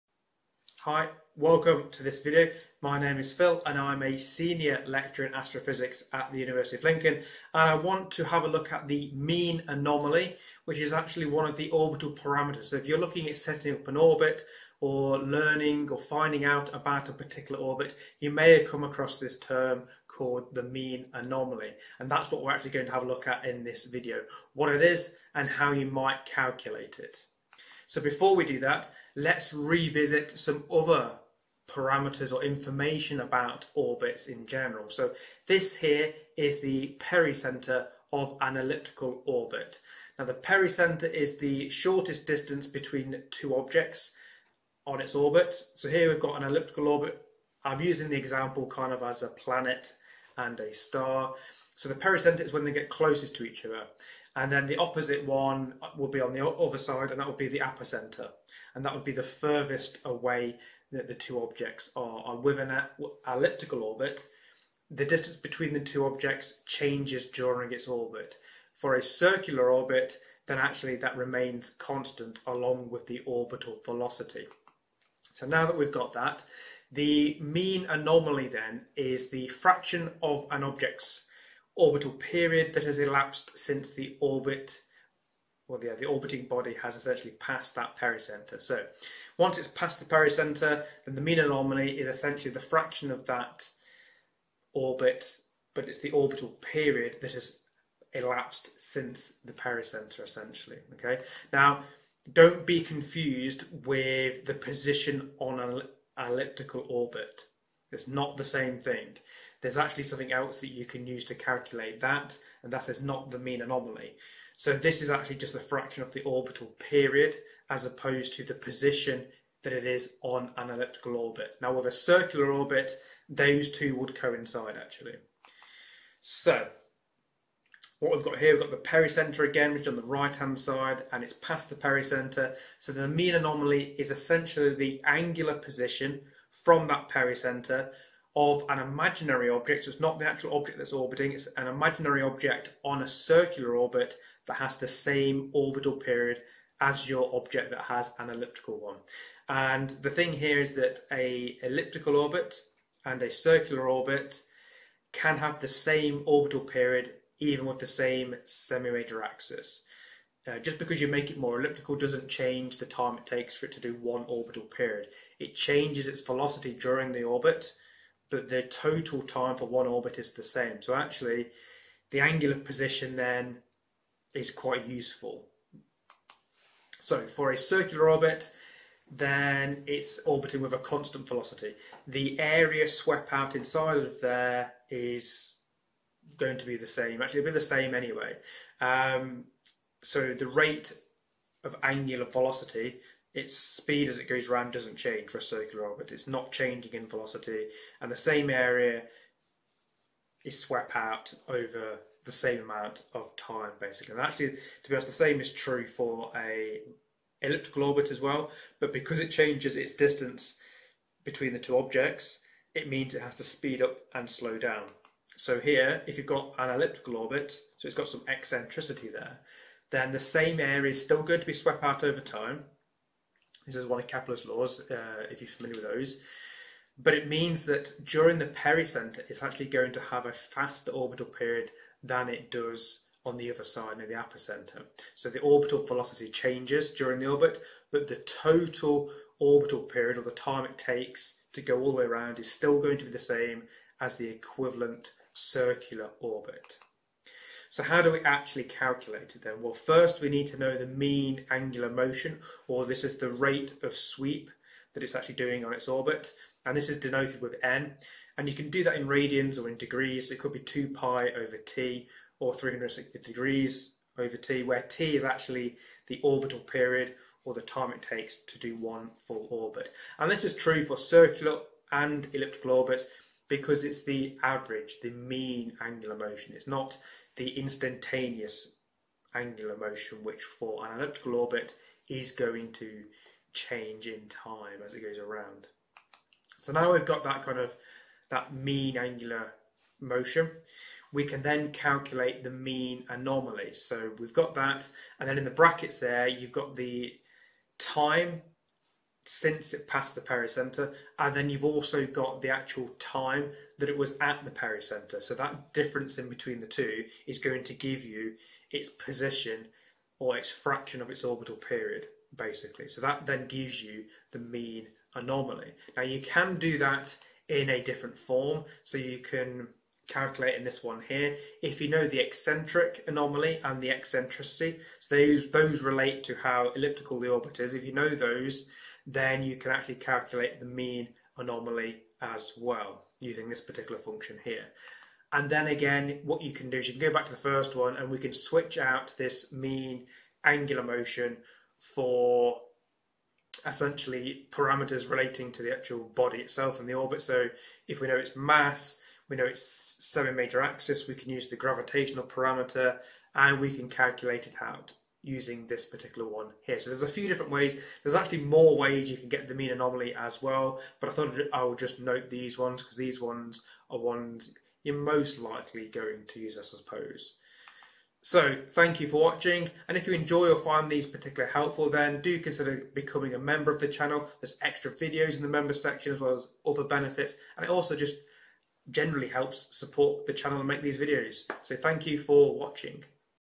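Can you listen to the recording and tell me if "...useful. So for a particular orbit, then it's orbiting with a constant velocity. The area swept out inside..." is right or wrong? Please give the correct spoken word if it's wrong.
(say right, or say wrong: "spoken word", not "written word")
wrong: "circular", not "particular".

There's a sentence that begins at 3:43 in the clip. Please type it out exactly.
This is one of Kepler's laws, uh, if you're familiar with those.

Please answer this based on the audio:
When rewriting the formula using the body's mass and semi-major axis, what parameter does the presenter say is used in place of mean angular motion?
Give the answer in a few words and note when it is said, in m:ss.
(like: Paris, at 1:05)
gravitational parameter, at 5:51.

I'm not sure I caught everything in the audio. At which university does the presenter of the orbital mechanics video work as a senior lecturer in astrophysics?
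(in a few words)
University of Lincoln.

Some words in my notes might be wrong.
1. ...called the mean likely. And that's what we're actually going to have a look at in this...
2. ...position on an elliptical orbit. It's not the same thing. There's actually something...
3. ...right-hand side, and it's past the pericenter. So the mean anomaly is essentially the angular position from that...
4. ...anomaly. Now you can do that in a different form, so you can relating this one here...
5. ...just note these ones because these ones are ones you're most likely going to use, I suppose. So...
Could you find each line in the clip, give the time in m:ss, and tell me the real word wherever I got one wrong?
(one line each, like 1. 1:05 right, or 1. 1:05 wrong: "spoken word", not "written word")
1. 0:20 wrong: "anomaly", not "likely"
2. 1:44 right
3. 2:10 right
4. 5:15 wrong: "calculating", not "relating"
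5. 6:01 right.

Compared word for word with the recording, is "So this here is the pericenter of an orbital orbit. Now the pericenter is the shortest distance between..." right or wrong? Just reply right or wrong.
wrong.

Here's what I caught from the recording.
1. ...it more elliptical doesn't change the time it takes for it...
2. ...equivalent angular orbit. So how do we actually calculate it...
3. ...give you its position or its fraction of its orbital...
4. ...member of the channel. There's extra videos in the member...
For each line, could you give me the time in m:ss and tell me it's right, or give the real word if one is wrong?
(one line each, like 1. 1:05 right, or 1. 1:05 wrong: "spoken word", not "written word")
1. 2:41 right
2. 4:04 wrong: "circular", not "angular"
3. 5:07 right
4. 6:13 right.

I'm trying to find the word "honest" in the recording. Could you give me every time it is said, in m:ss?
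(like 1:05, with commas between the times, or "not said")
3:24.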